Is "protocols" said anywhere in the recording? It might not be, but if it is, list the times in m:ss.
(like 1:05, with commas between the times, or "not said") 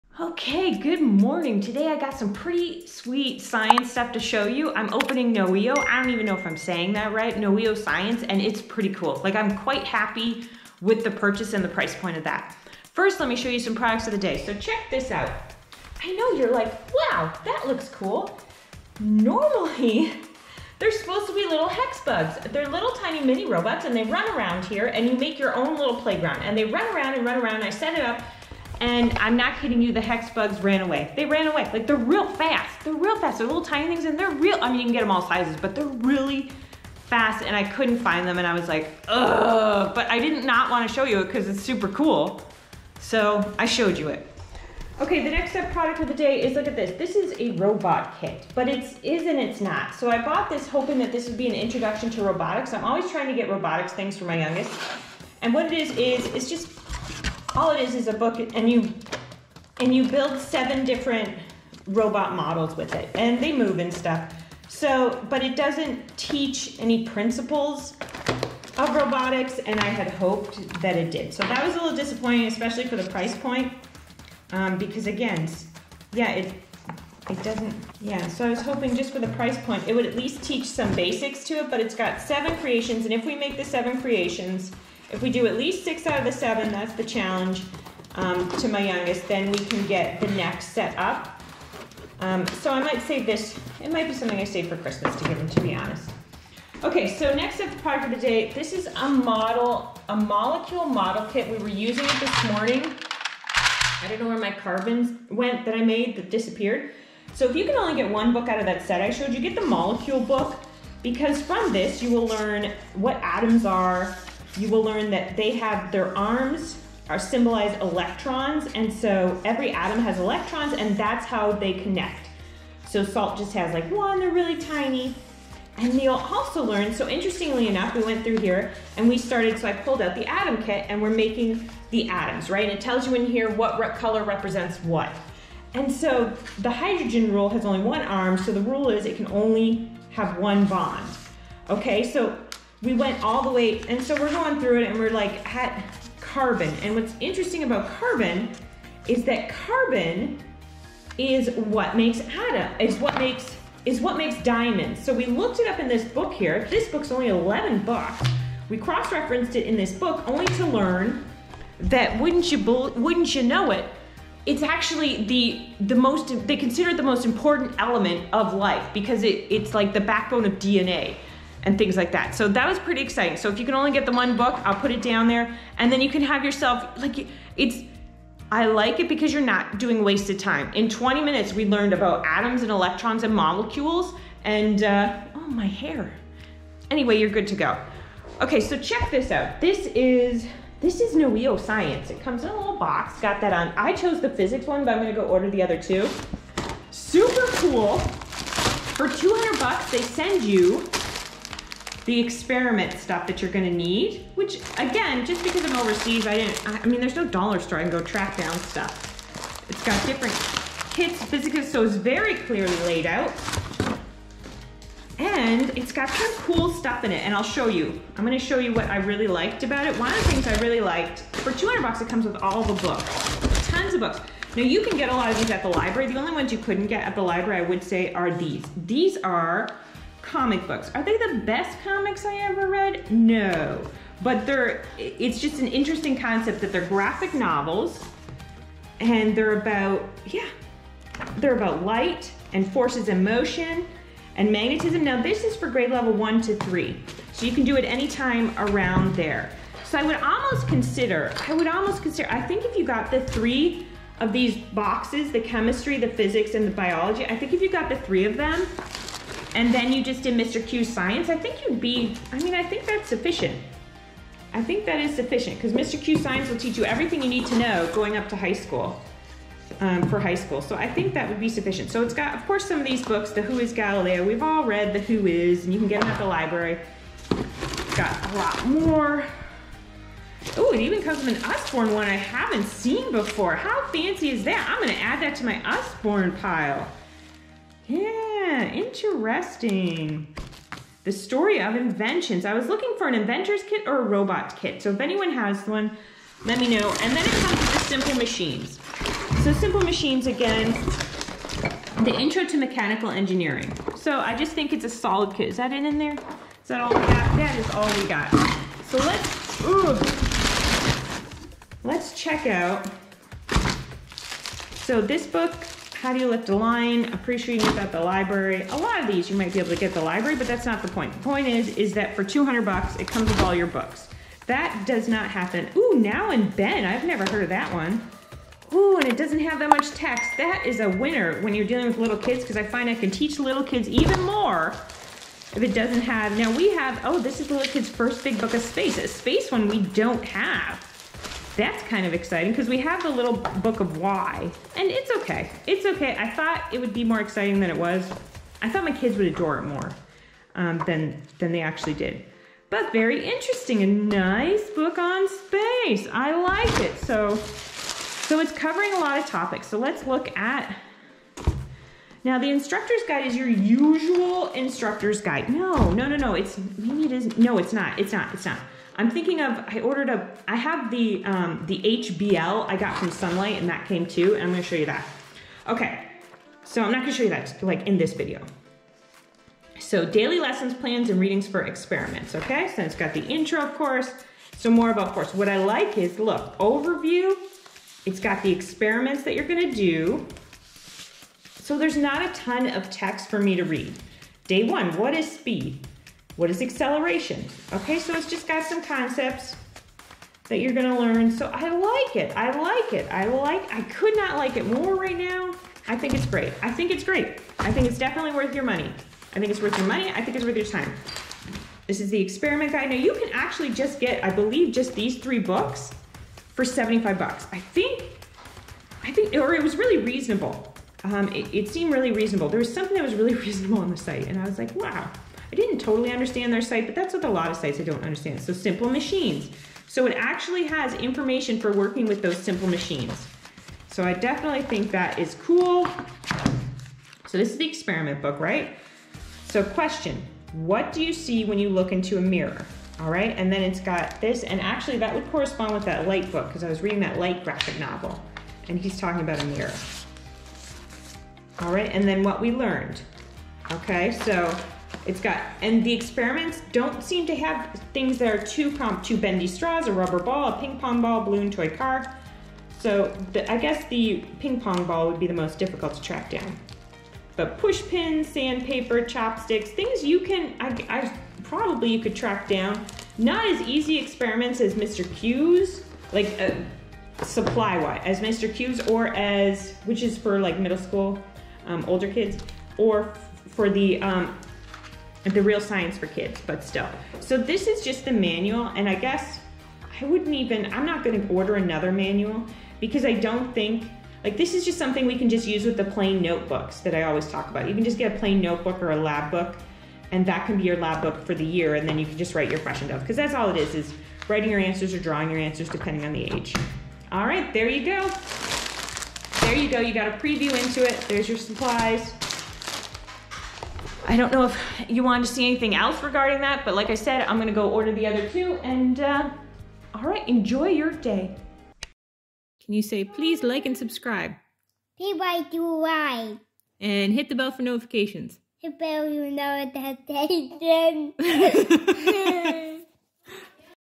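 not said.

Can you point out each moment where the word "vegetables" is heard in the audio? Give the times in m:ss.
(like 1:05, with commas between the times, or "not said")
not said.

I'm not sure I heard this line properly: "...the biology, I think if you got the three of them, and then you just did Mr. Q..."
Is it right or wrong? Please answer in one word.
right.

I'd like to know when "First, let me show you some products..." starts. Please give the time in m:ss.
0:12.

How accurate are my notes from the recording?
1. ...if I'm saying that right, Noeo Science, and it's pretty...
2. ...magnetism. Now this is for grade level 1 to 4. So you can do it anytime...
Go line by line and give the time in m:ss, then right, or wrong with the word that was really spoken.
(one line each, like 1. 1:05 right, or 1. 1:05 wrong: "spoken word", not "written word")
1. 0:06 right
2. 4:04 wrong: "3", not "4".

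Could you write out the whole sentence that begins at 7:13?
So I definitely think that is cool.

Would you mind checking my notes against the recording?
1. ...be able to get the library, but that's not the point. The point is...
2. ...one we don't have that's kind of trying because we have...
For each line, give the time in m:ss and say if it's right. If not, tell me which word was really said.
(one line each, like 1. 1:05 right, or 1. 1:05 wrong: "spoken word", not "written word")
1. 5:19 right
2. 5:39 wrong: "exciting", not "trying".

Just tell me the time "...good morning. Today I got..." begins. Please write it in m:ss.
0:00.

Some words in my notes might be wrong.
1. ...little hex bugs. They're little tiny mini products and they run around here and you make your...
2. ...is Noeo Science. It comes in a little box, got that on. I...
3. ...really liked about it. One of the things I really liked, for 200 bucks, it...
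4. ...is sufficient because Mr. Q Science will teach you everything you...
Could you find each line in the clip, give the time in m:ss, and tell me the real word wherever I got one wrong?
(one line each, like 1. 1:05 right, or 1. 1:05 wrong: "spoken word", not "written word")
1. 0:21 wrong: "robots", not "products"
2. 3:10 right
3. 3:38 right
4. 4:24 right.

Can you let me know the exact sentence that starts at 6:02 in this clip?
Now, the instructor's guide is your usual instructor's guide.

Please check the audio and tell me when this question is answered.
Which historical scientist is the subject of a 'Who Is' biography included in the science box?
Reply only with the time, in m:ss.
4:33.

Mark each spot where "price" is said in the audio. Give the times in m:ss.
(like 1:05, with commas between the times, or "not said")
0:11, 1:13, 1:19.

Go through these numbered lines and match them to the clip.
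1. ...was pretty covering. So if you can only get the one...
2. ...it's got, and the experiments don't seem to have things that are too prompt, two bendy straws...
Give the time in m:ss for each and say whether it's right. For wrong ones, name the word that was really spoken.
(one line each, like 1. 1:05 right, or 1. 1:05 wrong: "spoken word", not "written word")
1. 2:52 wrong: "exciting", not "covering"
2. 7:35 right.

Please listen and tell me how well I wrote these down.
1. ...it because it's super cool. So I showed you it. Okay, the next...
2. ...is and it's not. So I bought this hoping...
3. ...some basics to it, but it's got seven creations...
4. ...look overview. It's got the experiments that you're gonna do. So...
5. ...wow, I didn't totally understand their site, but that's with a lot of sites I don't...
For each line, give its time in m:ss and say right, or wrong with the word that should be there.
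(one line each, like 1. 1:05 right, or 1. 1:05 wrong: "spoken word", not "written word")
1. 0:41 right
2. 0:49 right
3. 1:20 right
4. 6:26 right
5. 7:04 right.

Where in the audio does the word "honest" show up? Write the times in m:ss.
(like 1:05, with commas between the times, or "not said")
1:35.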